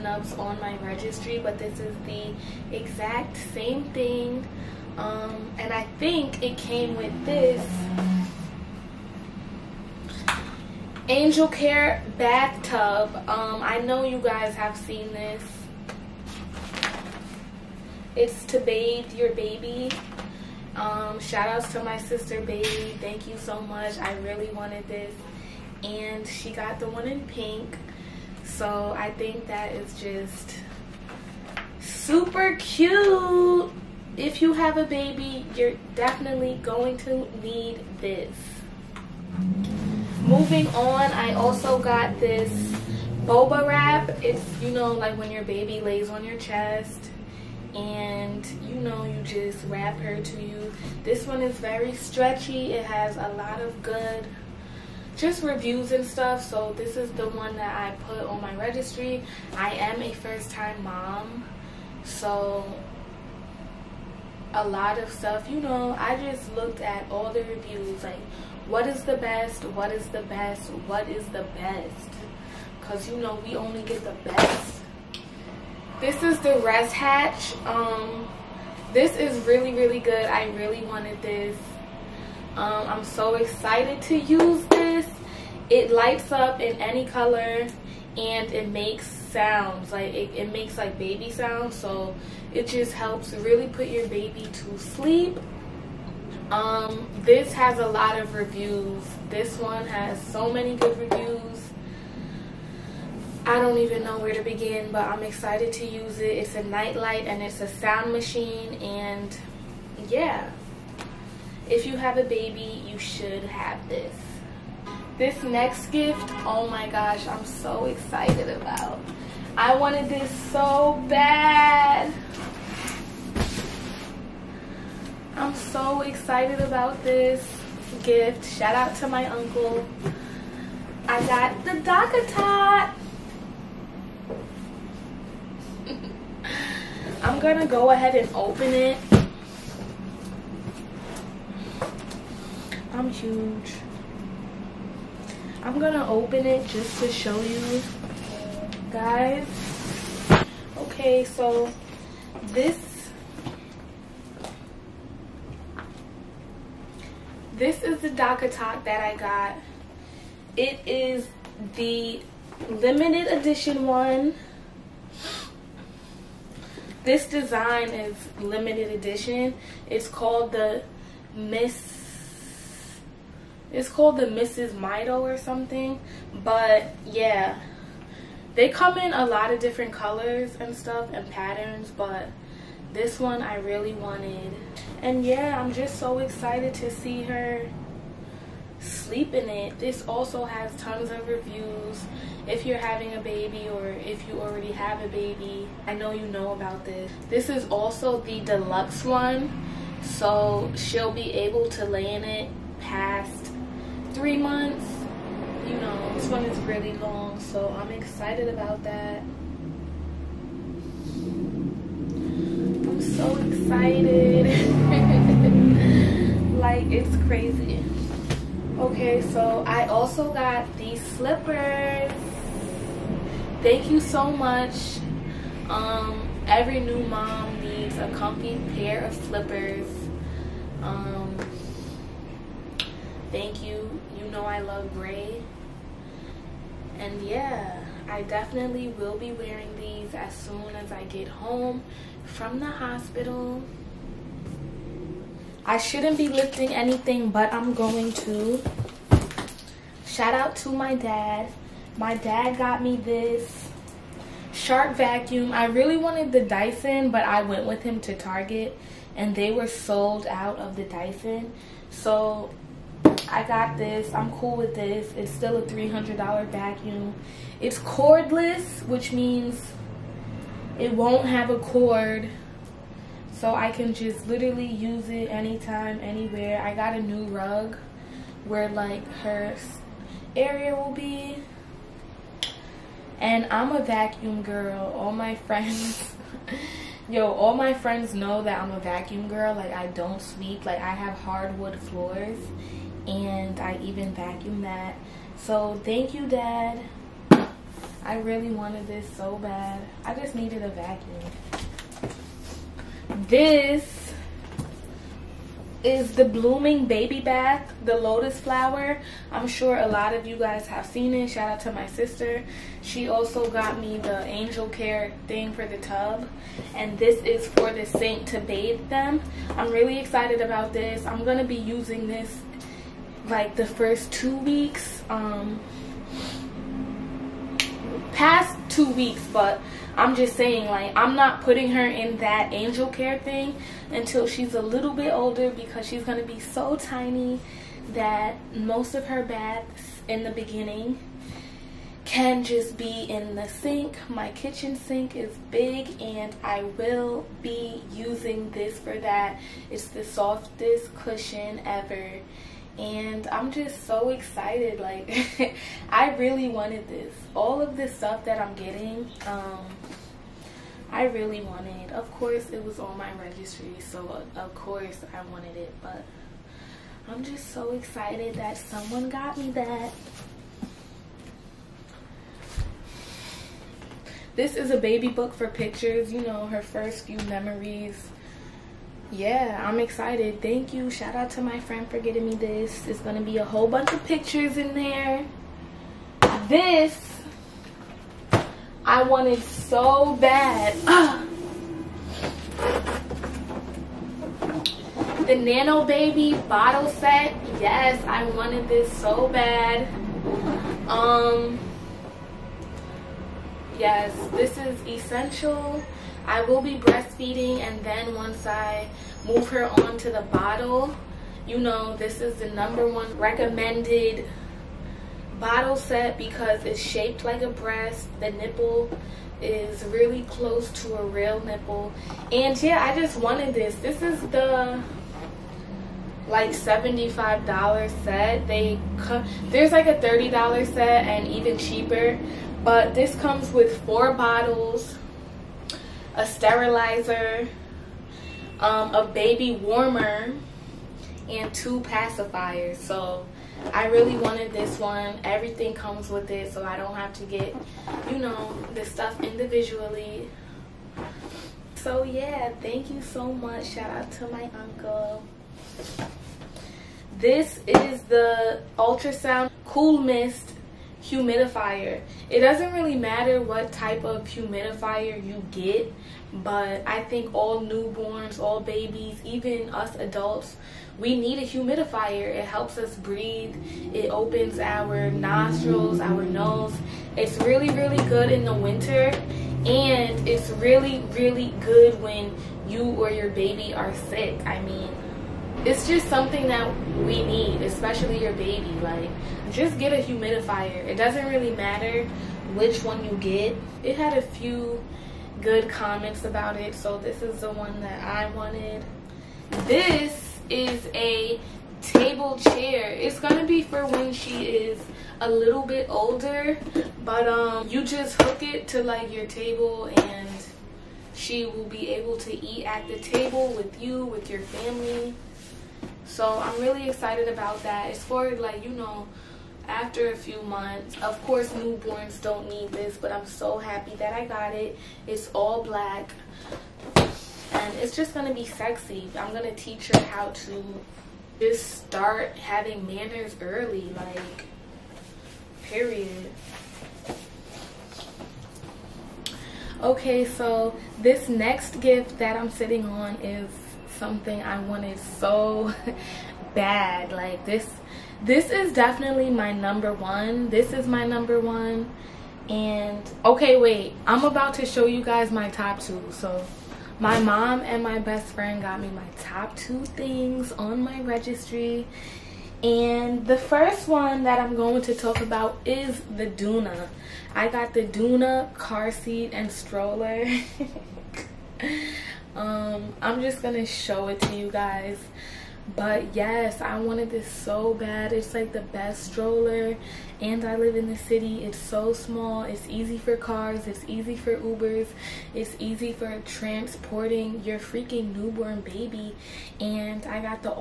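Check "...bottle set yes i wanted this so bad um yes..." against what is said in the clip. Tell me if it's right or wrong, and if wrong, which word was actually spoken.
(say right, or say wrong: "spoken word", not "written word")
right.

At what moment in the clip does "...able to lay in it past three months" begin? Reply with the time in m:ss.
3:21.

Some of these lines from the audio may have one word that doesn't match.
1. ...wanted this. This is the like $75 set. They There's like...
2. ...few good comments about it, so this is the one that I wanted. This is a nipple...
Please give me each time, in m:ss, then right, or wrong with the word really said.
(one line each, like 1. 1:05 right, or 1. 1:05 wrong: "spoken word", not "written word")
1. 7:03 right
2. 8:14 wrong: "table", not "nipple".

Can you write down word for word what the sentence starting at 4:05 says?
I shouldn't be lifting anything, but I'm going to.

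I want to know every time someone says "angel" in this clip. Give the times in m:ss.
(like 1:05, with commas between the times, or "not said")
0:11, 5:14, 5:32.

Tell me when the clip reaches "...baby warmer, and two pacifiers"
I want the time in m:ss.
7:19.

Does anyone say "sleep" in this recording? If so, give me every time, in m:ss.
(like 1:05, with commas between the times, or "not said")
1:34, 3:08.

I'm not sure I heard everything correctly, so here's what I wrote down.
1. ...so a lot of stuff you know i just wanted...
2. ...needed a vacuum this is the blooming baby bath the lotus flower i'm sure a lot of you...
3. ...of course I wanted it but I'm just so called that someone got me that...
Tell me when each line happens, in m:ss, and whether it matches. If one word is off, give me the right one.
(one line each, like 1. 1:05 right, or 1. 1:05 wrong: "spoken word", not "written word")
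1. 1:02 wrong: "looked", not "wanted"
2. 5:00 right
3. 6:04 wrong: "excited", not "called".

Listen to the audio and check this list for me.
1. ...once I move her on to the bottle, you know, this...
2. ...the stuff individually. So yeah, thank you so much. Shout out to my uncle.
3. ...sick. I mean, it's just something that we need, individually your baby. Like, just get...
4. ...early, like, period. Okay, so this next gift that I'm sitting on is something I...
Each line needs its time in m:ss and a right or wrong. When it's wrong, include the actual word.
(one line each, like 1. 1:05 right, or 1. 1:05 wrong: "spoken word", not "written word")
1. 6:48 right
2. 7:28 right
3. 8:04 wrong: "especially", not "individually"
4. 8:53 right.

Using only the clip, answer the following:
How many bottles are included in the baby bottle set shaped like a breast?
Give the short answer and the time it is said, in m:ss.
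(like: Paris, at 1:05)
4, at 7:13.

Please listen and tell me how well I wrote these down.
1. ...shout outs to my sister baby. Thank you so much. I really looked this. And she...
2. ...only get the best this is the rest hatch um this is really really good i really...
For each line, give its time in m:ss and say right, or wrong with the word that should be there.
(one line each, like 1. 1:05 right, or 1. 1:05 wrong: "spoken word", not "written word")
1. 0:21 wrong: "wanted", not "looked"
2. 1:13 right.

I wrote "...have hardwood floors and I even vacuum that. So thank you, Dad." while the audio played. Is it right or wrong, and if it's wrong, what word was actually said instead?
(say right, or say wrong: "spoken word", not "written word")
right.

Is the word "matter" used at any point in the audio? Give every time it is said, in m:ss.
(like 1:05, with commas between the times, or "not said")
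7:42, 8:11.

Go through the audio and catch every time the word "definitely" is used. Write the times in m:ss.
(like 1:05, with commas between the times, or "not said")
0:35, 3:58, 9:08.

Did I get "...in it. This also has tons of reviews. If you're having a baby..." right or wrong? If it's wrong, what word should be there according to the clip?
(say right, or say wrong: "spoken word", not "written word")
right.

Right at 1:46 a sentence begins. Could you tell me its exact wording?
It's a nightlight and it's a sound machine, and yeah.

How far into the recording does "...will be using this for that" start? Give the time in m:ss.
5:46.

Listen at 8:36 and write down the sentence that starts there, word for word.
So I'm really excited about that.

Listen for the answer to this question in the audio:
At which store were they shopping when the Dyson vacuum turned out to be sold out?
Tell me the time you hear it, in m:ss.
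4:18.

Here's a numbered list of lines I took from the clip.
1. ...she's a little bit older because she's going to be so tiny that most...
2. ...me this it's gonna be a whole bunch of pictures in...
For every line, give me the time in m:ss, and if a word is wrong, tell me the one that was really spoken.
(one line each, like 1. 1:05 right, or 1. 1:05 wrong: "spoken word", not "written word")
1. 5:34 right
2. 6:22 right.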